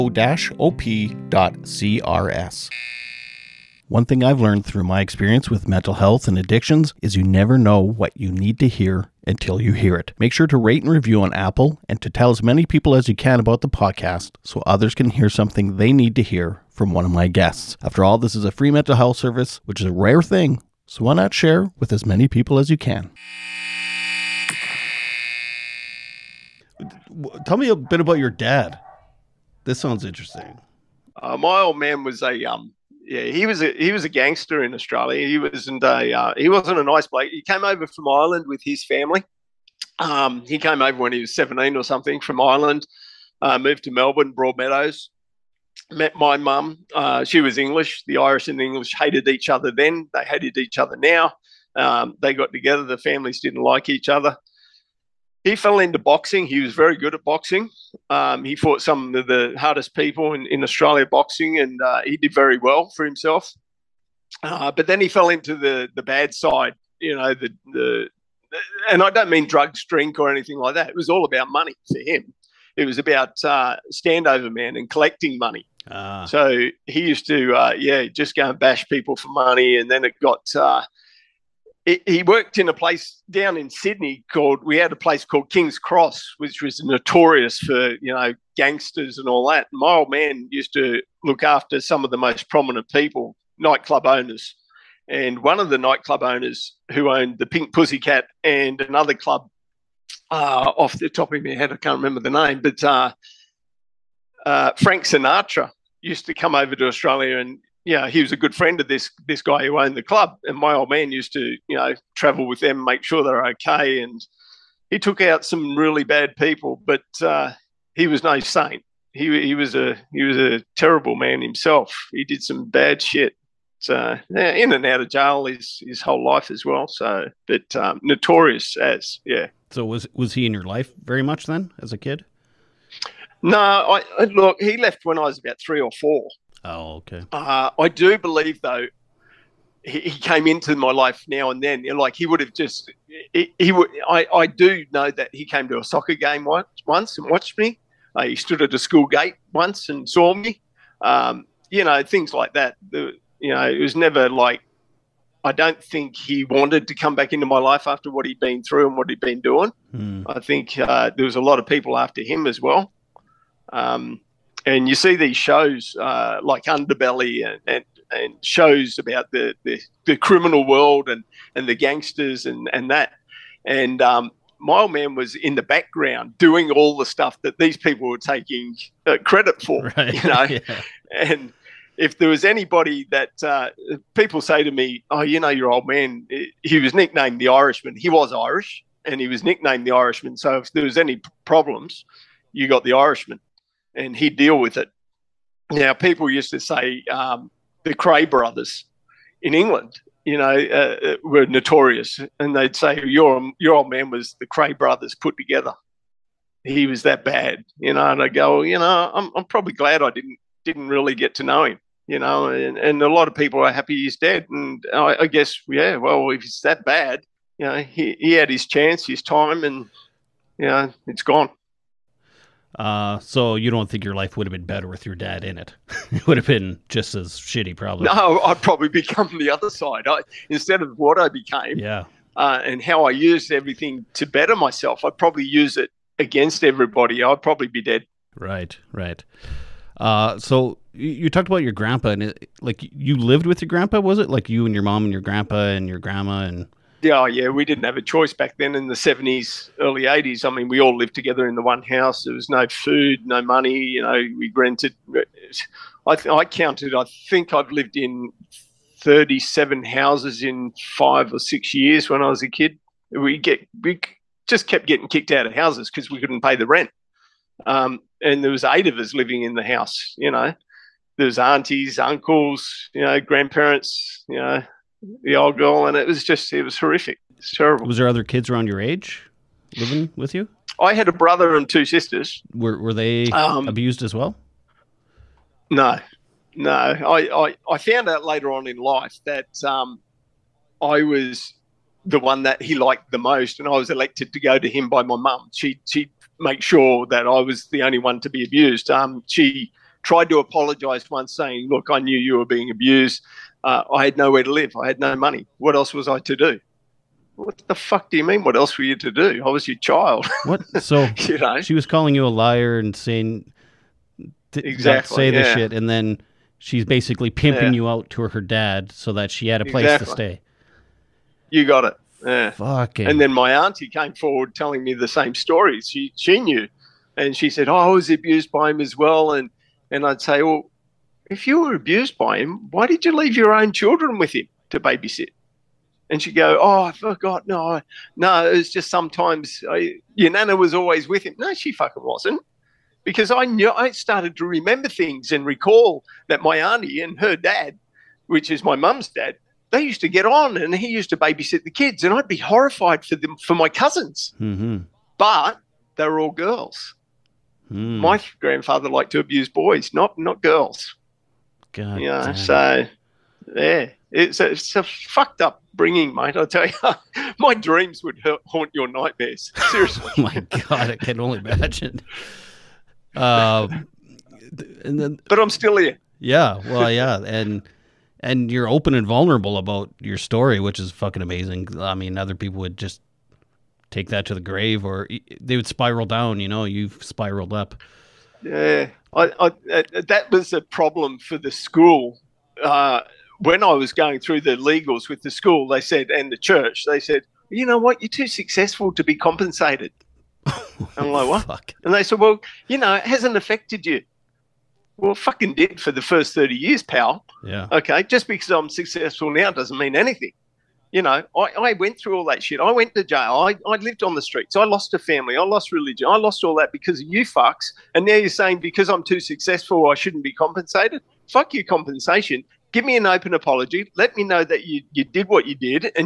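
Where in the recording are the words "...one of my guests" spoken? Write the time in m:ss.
0:16.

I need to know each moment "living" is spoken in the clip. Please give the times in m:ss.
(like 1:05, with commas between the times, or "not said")
4:29, 4:39.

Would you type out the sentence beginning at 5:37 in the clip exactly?
No, no, it was just sometimes I, your nana was always with him.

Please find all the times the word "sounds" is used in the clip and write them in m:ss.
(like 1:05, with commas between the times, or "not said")
0:29.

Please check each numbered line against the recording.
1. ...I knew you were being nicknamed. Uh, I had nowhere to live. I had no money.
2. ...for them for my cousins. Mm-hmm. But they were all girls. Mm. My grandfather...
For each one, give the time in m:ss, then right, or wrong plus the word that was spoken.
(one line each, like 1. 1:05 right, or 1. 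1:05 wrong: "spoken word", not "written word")
1. 5:01 wrong: "abused", not "nicknamed"
2. 5:53 right.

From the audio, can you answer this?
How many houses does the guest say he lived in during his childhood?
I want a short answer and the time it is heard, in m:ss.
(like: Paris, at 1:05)
37, at 4:19.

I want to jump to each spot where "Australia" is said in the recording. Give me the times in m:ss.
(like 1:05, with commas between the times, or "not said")
0:34, 1:00, 1:46.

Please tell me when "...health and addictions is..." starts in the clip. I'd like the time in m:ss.
0:05.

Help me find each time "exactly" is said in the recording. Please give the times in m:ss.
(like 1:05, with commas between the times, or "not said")
5:14, 5:19.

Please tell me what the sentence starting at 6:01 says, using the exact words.
God you so yeah, it's a, it's a fucked up bringing, mate.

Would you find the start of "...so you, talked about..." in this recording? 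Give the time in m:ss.
4:00.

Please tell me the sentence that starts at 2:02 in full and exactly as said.
He did some bad shit, uh, in and out of jail his, his whole life as well.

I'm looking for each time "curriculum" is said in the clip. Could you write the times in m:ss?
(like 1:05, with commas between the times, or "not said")
not said.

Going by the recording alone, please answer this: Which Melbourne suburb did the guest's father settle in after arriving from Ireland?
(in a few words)
Broadmeadows.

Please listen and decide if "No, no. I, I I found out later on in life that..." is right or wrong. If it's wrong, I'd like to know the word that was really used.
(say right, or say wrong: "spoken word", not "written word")
right.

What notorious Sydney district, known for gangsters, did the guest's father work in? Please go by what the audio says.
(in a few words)
King's Cross.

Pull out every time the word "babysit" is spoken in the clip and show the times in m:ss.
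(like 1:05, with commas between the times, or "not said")
5:34, 5:51.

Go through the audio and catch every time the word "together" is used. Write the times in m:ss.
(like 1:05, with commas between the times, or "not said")
0:52, 3:25, 4:11.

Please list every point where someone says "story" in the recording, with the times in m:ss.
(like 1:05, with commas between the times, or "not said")
5:25, 6:20.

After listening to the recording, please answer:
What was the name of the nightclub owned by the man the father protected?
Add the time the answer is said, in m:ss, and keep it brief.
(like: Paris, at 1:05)
Pink Pussycat, at 1:37.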